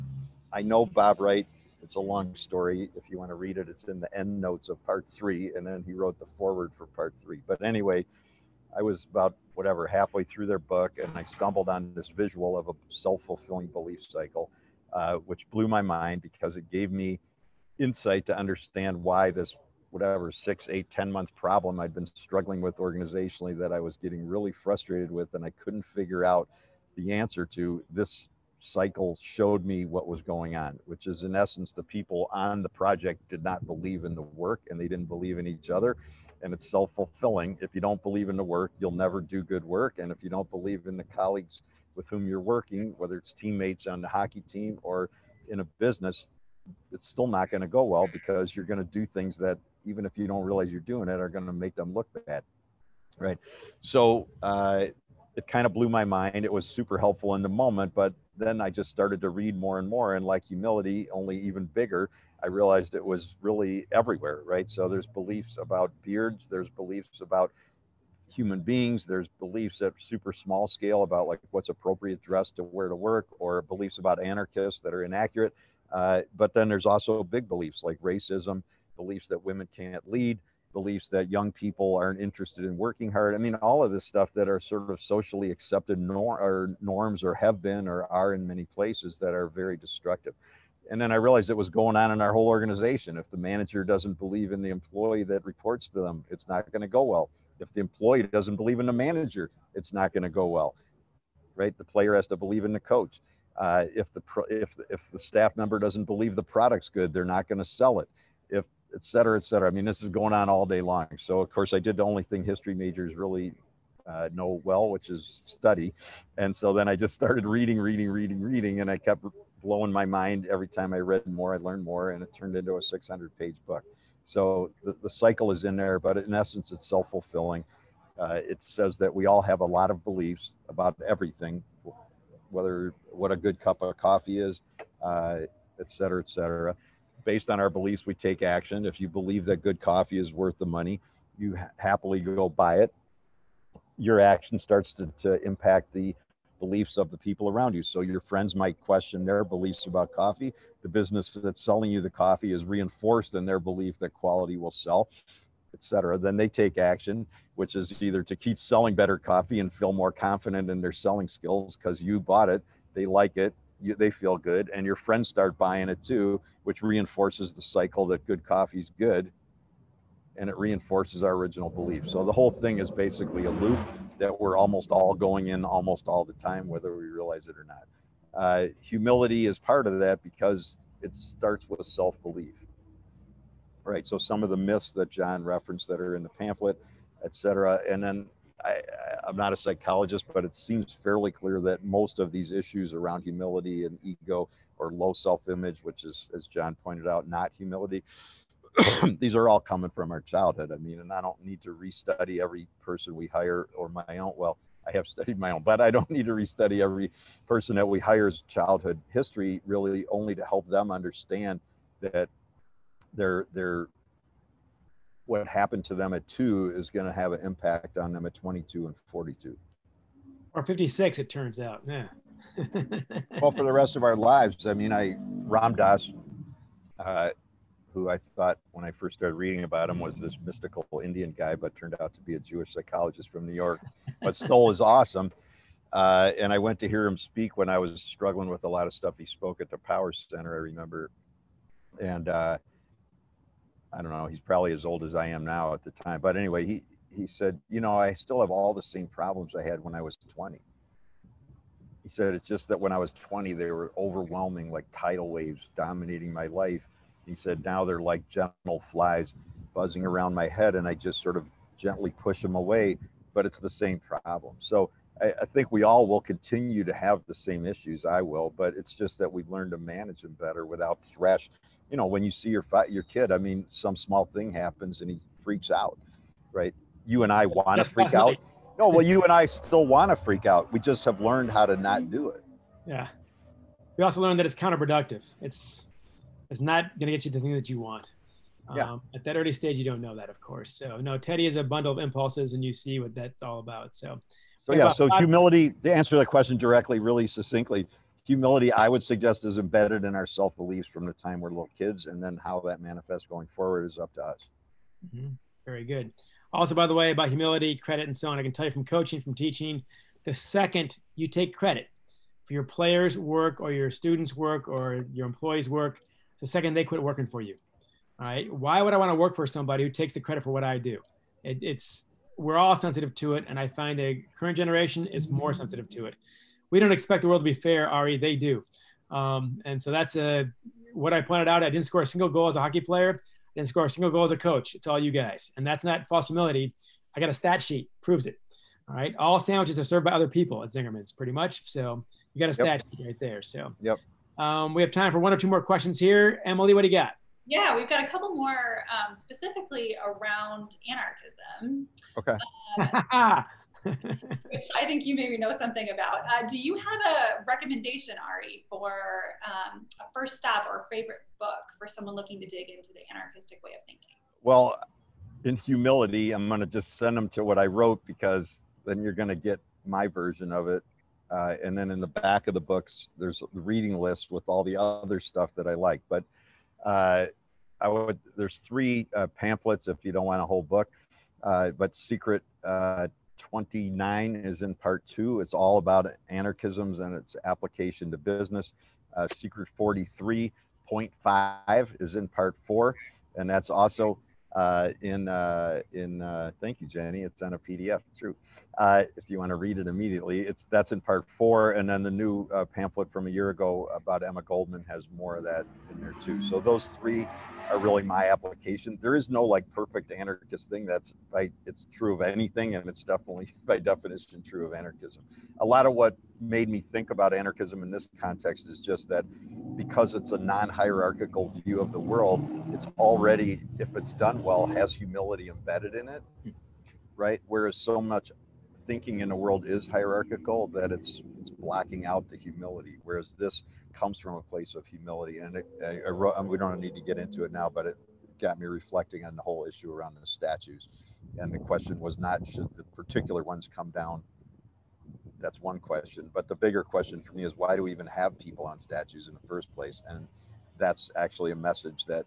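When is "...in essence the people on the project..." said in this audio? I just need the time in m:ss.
0:31.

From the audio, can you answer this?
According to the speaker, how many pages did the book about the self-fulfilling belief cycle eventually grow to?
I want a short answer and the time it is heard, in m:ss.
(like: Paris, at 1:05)
600, at 2:02.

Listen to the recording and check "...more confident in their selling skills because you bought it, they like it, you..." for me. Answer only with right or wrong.
right.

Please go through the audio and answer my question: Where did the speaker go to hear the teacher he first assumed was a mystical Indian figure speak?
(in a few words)
The Power Center.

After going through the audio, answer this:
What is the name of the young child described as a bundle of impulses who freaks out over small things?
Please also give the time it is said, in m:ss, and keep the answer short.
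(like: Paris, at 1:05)
Teddy, at 4:51.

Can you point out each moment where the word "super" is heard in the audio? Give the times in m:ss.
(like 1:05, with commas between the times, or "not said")
0:56, 1:09.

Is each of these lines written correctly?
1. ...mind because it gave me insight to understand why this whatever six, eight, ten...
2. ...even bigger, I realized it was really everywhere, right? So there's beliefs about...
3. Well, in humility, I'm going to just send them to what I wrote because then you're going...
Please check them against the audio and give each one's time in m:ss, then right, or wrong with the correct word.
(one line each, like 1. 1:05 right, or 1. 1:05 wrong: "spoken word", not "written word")
1. 0:15 right
2. 1:01 right
3. 6:04 right.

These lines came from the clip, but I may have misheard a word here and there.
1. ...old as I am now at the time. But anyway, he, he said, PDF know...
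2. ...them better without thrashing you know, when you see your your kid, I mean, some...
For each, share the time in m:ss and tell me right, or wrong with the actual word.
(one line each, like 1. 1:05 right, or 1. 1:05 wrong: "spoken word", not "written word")
1. 4:04 wrong: "You", not "PDF"
2. 4:30 right.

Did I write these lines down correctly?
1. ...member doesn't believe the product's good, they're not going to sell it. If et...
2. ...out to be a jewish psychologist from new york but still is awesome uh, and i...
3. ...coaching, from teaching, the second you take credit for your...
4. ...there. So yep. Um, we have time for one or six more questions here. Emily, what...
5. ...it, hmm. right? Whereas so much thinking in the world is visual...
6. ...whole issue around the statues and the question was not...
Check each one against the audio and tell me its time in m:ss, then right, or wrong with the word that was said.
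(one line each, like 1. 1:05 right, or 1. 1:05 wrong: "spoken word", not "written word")
1. 1:45 right
2. 3:52 right
3. 5:08 right
4. 5:43 wrong: "two", not "six"
5. 7:06 wrong: "hierarchical", not "visual"
6. 7:19 right.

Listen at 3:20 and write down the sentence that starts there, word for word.
I mean, and I don't need to restudy every person we hire or my own.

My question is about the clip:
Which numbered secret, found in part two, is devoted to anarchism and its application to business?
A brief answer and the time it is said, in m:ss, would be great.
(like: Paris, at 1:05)
Secret 29, at 6:21.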